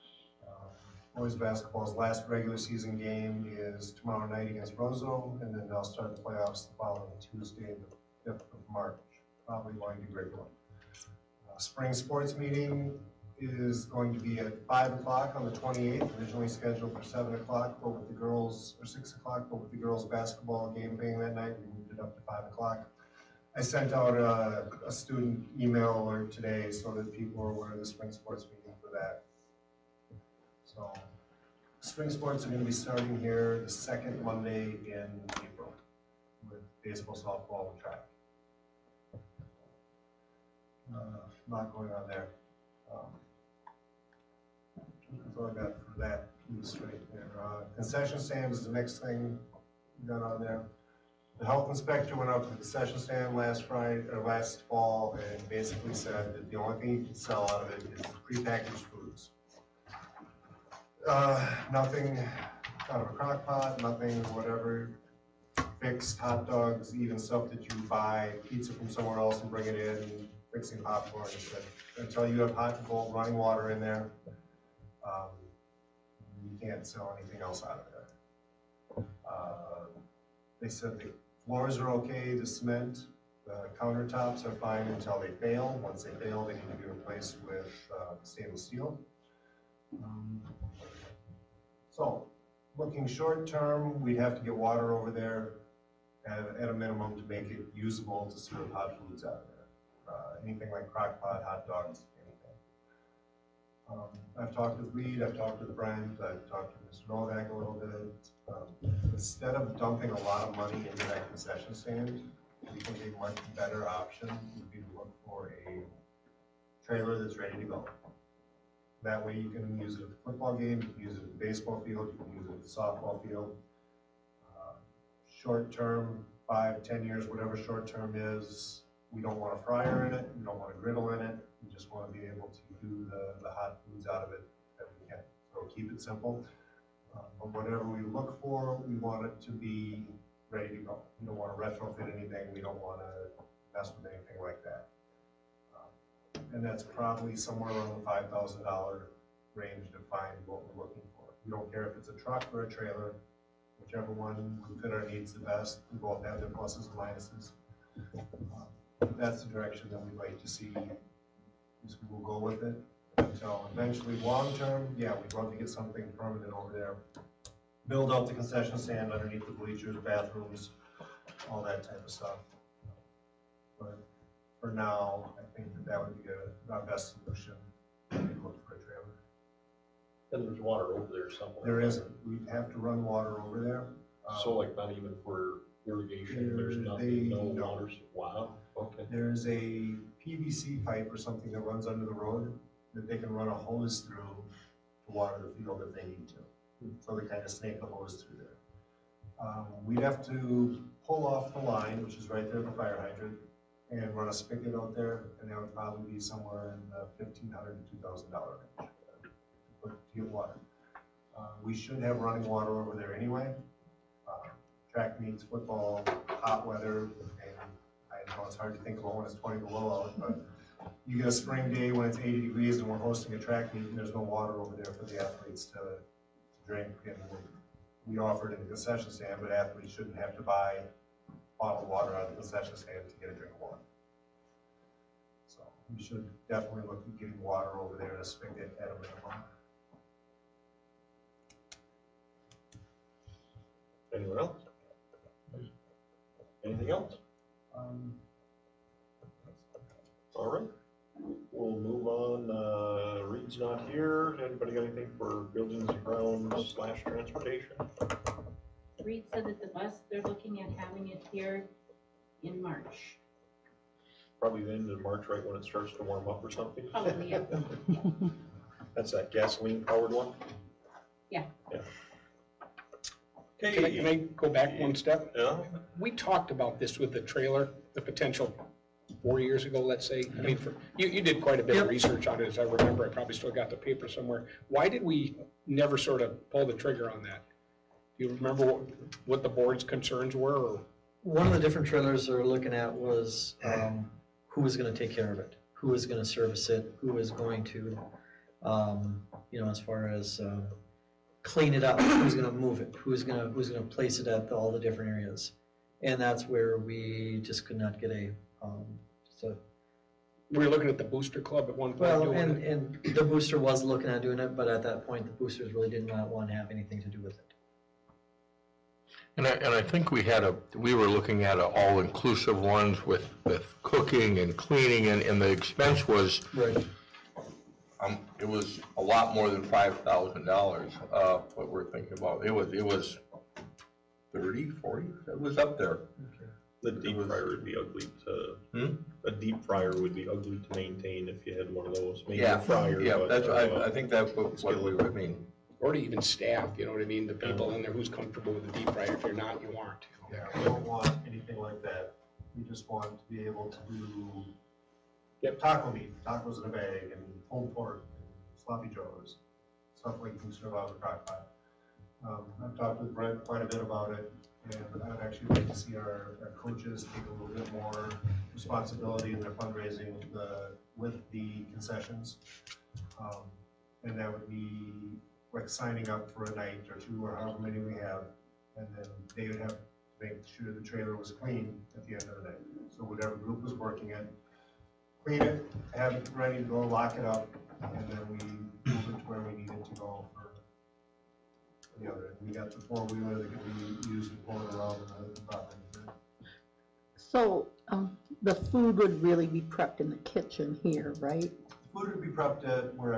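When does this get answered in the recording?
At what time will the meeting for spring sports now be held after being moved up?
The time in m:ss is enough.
0:14.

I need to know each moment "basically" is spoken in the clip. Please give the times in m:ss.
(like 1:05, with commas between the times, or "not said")
0:55.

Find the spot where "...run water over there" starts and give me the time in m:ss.
3:02.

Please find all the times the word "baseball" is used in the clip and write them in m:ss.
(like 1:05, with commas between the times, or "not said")
0:36, 2:01.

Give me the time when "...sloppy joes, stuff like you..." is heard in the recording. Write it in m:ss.
5:58.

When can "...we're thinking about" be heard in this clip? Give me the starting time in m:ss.
5:31.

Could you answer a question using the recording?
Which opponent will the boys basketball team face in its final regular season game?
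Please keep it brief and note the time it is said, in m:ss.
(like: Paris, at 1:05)
Roseau, at 0:04.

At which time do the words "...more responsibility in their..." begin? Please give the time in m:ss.
6:07.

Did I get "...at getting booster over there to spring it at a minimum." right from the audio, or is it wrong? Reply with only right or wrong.
wrong.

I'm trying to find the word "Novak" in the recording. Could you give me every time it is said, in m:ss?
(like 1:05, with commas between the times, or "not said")
1:47.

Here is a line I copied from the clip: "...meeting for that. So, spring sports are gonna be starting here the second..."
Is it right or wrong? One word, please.
right.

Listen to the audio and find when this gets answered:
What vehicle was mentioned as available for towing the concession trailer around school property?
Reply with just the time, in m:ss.
6:32.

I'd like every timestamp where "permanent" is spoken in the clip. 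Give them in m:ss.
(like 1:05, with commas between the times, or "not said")
2:46.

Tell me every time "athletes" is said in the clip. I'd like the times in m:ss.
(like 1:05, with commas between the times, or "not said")
3:45, 3:49.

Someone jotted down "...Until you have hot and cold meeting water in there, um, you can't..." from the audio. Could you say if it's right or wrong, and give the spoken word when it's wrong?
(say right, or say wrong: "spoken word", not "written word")
wrong: "running", not "meeting".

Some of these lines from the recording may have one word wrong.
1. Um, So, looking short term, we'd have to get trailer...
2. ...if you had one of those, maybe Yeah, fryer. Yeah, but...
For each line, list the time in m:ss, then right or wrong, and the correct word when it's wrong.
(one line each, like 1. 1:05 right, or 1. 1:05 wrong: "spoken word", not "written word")
1. 1:30 wrong: "water", not "trailer"
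2. 5:41 right.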